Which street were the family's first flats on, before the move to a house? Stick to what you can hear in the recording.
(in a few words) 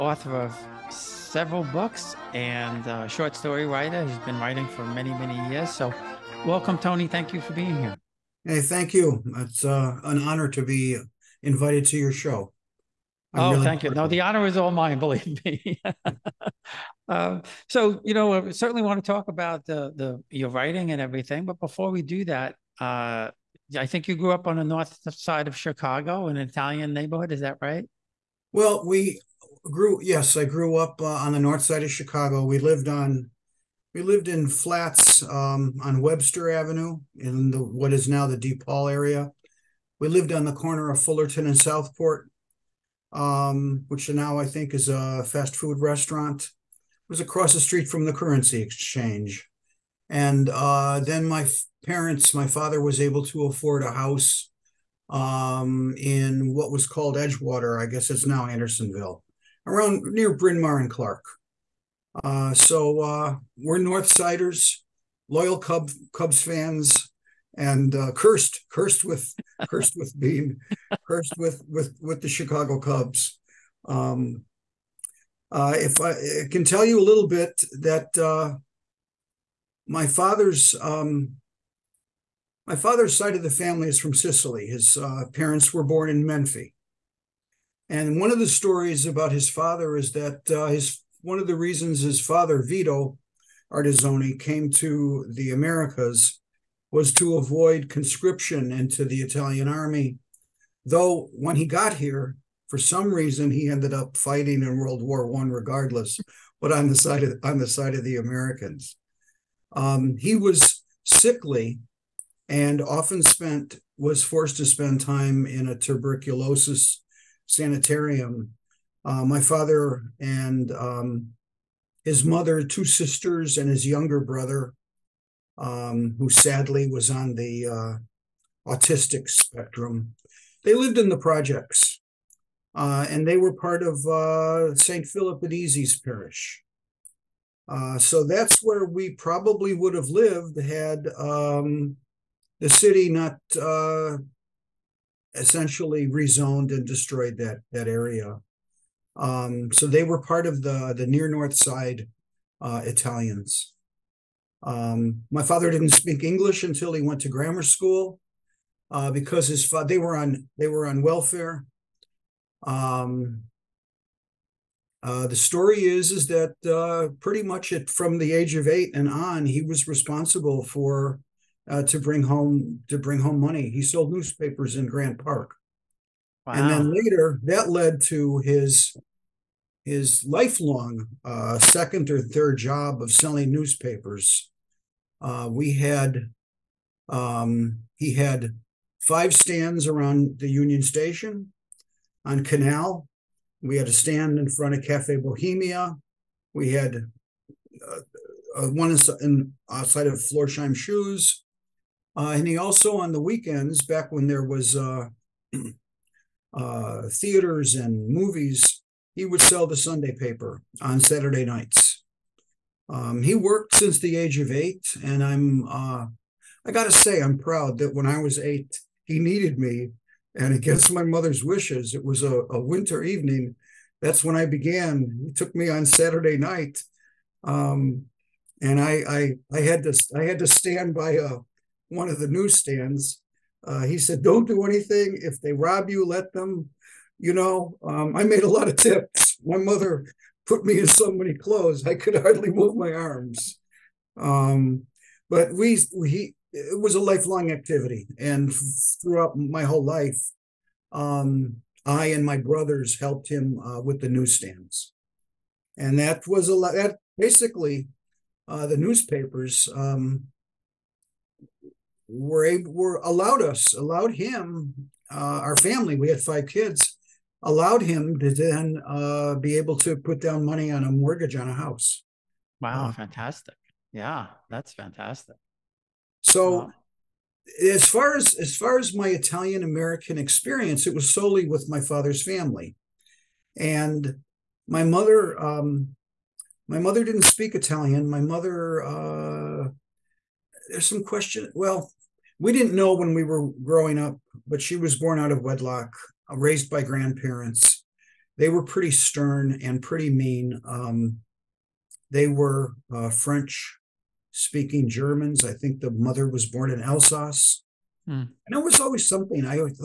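Webster Avenue.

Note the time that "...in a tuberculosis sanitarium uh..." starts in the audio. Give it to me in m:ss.
1:55.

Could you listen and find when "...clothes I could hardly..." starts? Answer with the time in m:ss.
4:01.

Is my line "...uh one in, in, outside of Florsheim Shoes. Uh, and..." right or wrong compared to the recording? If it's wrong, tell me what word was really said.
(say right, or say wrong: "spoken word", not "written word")
right.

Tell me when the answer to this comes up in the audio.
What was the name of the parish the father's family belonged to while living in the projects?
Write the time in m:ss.
2:14.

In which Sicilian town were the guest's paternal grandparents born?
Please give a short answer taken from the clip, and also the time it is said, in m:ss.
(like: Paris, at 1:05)
Menfi, at 1:26.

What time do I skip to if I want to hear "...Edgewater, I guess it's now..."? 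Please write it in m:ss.
0:57.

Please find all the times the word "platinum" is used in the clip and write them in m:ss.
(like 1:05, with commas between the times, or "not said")
not said.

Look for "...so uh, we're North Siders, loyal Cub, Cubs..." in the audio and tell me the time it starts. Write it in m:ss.
1:02.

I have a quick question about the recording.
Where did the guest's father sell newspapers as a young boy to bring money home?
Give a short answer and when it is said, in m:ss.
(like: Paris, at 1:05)
Grant Park, at 2:54.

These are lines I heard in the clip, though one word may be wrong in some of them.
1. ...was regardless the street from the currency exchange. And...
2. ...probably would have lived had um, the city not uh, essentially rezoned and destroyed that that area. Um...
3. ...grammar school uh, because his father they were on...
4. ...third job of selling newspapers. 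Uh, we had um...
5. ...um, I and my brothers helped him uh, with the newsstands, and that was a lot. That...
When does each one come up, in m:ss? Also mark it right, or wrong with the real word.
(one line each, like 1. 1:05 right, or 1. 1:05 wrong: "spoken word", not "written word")
1. 0:47 wrong: "across", not "regardless"
2. 2:19 right
3. 2:37 right
4. 3:02 right
5. 4:10 right.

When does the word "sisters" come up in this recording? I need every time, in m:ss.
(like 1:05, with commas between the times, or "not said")
2:02.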